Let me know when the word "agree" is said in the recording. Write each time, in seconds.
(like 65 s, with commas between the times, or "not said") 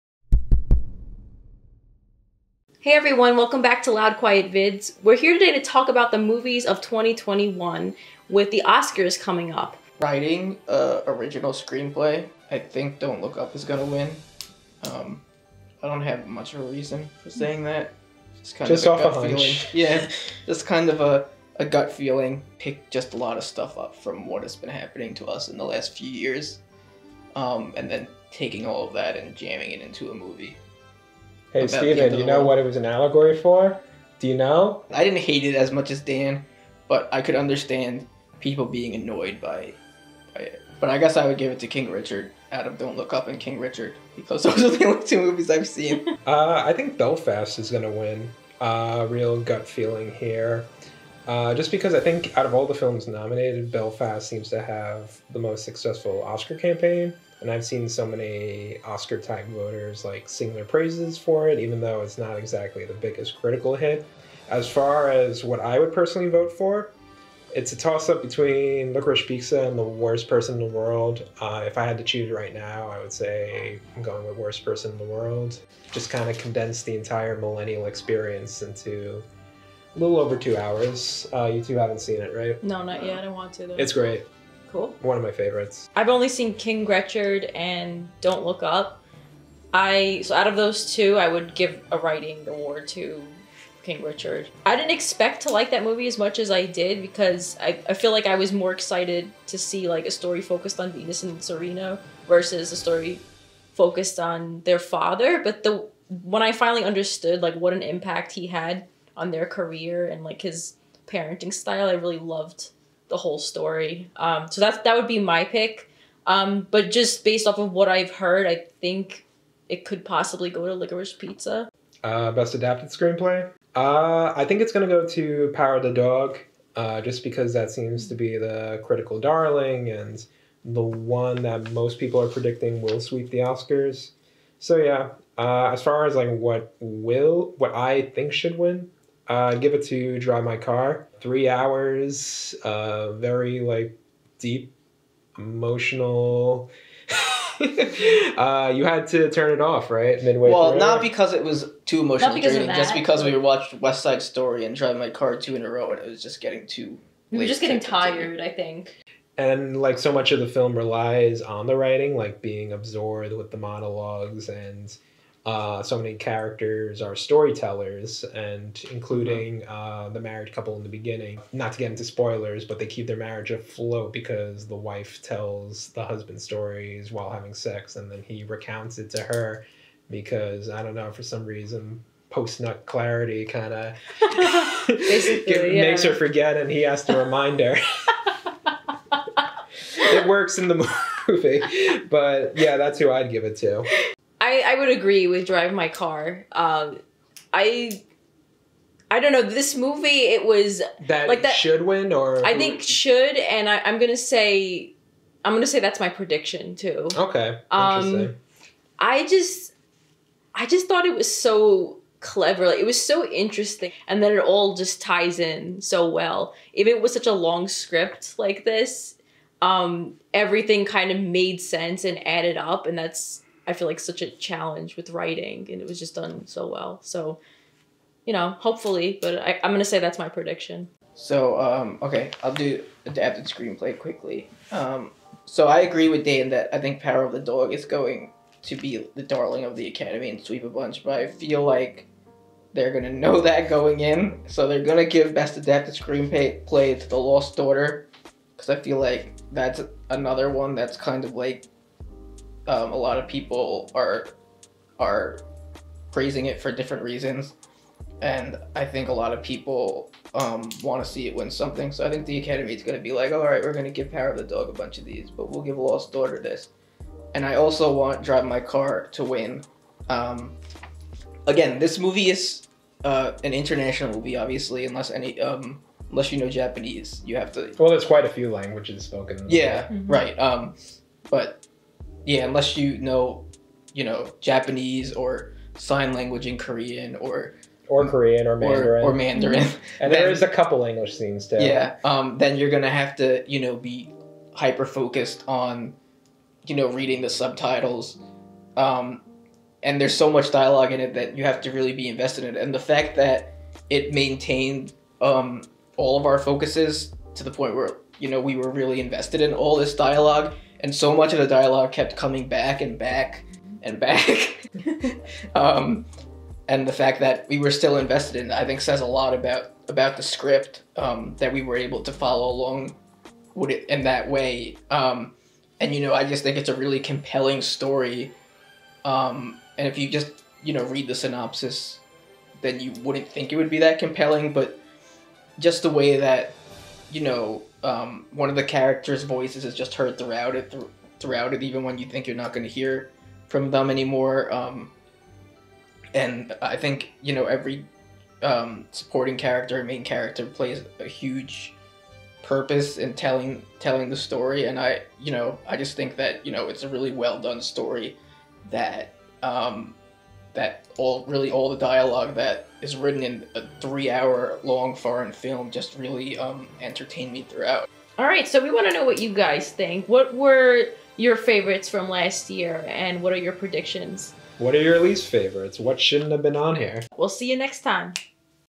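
194 s, 235 s.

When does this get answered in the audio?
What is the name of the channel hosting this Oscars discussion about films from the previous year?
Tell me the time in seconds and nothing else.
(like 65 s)
3 s.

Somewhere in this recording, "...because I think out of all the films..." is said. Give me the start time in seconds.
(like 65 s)
51 s.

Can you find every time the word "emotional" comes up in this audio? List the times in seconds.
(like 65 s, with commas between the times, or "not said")
145 s, 152 s.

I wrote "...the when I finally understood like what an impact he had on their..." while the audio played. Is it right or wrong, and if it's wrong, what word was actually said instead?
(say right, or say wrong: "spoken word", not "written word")
right.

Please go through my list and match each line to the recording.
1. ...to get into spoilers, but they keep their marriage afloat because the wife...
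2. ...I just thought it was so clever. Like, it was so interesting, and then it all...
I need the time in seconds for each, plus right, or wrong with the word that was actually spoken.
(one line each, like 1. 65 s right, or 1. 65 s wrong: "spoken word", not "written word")
1. 171 s right
2. 210 s right.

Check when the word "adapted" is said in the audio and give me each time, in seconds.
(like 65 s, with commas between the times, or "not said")
122 s, 233 s, 245 s.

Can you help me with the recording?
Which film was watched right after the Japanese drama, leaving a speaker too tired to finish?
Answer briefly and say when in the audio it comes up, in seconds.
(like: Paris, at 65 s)
West Side Story, at 153 s.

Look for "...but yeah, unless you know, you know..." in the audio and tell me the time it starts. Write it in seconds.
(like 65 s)
281 s.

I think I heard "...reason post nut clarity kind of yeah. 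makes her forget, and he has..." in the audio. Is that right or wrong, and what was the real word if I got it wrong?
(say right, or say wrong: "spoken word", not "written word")
right.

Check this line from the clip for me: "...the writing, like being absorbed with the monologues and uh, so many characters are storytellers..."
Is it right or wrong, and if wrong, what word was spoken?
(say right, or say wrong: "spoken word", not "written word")
right.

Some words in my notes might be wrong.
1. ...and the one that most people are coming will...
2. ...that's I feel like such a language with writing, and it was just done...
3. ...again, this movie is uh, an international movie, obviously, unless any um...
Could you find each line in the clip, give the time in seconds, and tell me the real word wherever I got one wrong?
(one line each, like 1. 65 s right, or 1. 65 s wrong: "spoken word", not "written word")
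1. 129 s wrong: "predicting", not "coming"
2. 222 s wrong: "challenge", not "language"
3. 271 s right.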